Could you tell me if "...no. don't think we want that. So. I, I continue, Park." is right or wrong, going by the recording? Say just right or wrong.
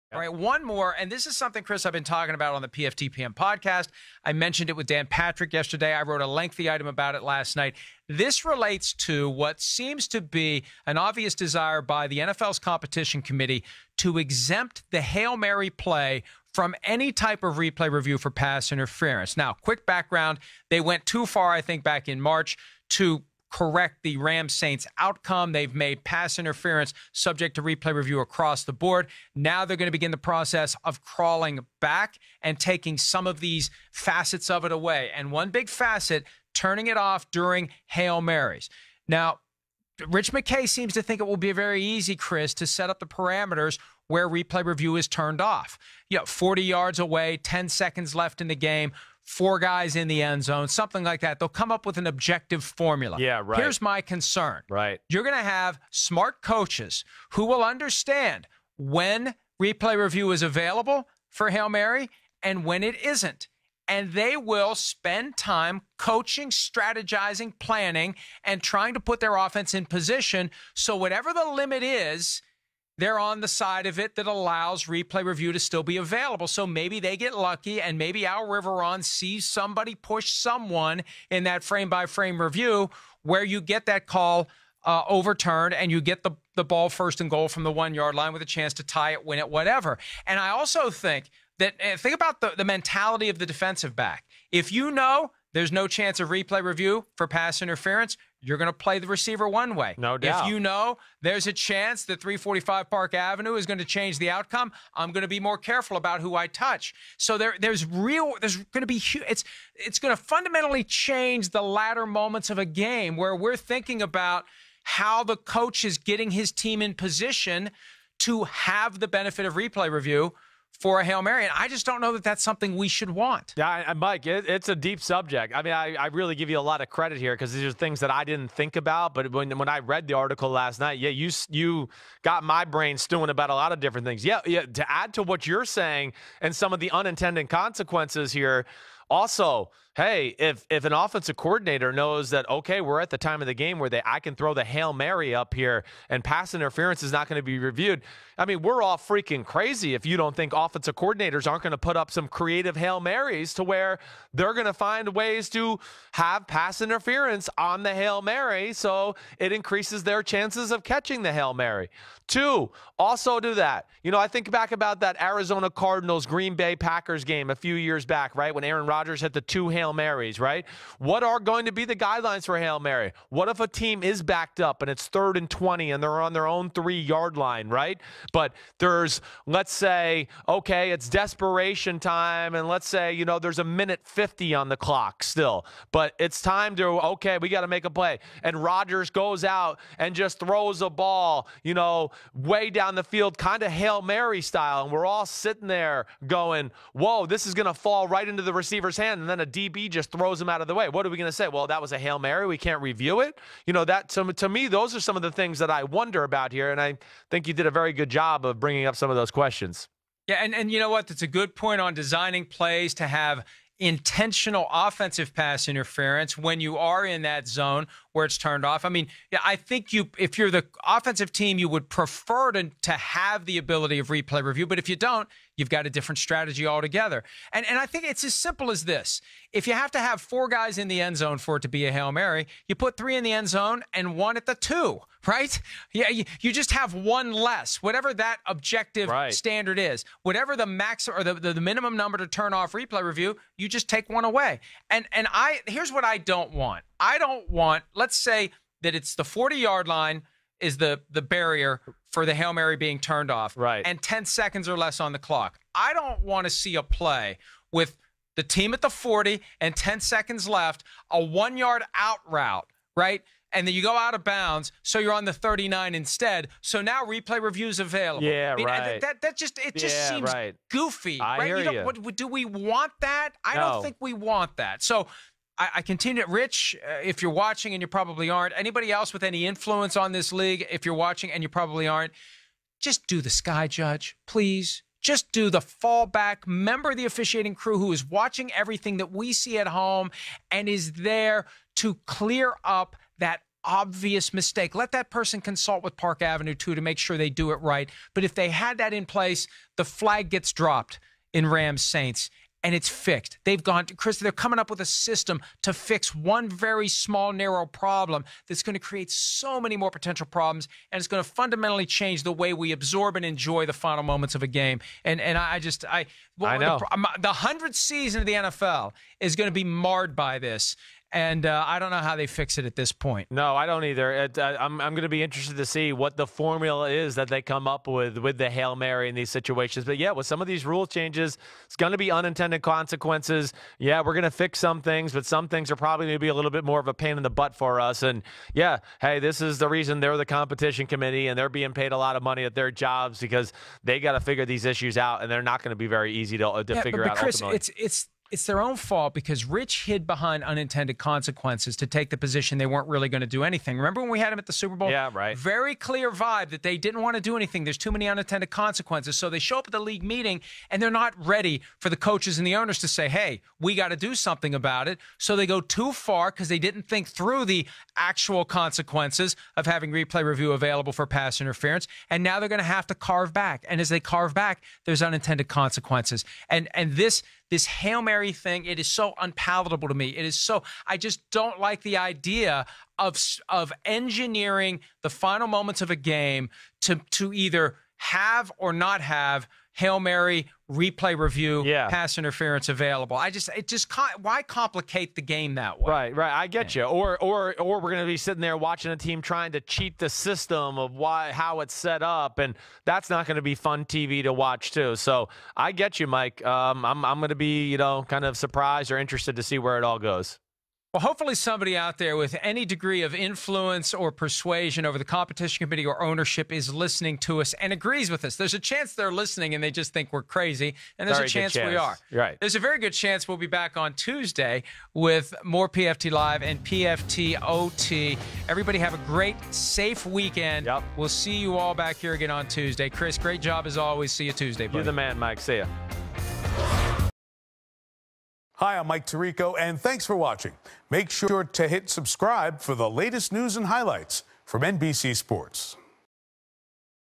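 wrong.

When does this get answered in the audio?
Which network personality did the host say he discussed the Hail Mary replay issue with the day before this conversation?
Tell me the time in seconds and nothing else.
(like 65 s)
4 s.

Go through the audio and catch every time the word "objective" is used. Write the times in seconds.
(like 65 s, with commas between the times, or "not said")
52 s, 238 s.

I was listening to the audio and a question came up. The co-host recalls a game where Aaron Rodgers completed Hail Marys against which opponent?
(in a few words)
Arizona Cardinals.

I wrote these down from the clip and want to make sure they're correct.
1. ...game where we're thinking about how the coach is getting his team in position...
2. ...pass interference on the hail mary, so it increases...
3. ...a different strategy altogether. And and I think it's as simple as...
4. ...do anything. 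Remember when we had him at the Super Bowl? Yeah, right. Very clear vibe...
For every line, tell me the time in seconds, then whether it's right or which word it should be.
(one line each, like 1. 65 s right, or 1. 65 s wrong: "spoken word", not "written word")
1. 112 s right
2. 156 s right
3. 225 s right
4. 353 s right.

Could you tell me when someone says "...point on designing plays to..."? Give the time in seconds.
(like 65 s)
211 s.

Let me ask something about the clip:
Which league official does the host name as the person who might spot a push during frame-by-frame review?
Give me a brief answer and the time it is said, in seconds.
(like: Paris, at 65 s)
Al Riveron, at 78 s.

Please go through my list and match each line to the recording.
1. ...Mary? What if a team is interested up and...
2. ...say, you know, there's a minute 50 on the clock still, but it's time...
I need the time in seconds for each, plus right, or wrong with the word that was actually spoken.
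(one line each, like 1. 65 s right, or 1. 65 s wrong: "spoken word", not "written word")
1. 172 s wrong: "backed", not "interested"
2. 182 s right.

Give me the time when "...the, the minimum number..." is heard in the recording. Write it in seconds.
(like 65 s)
241 s.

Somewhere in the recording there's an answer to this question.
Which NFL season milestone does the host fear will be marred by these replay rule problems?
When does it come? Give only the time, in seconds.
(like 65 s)
317 s.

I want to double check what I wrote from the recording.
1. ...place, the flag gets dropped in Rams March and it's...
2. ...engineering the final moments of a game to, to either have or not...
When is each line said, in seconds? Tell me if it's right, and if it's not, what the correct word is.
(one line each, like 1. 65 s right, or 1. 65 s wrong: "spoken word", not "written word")
1. 299 s wrong: "Saints", not "March"
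2. 383 s right.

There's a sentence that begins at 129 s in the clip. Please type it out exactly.
But when, when I read the article last night, yeah, you, you got my brain stewing about a lot of different things.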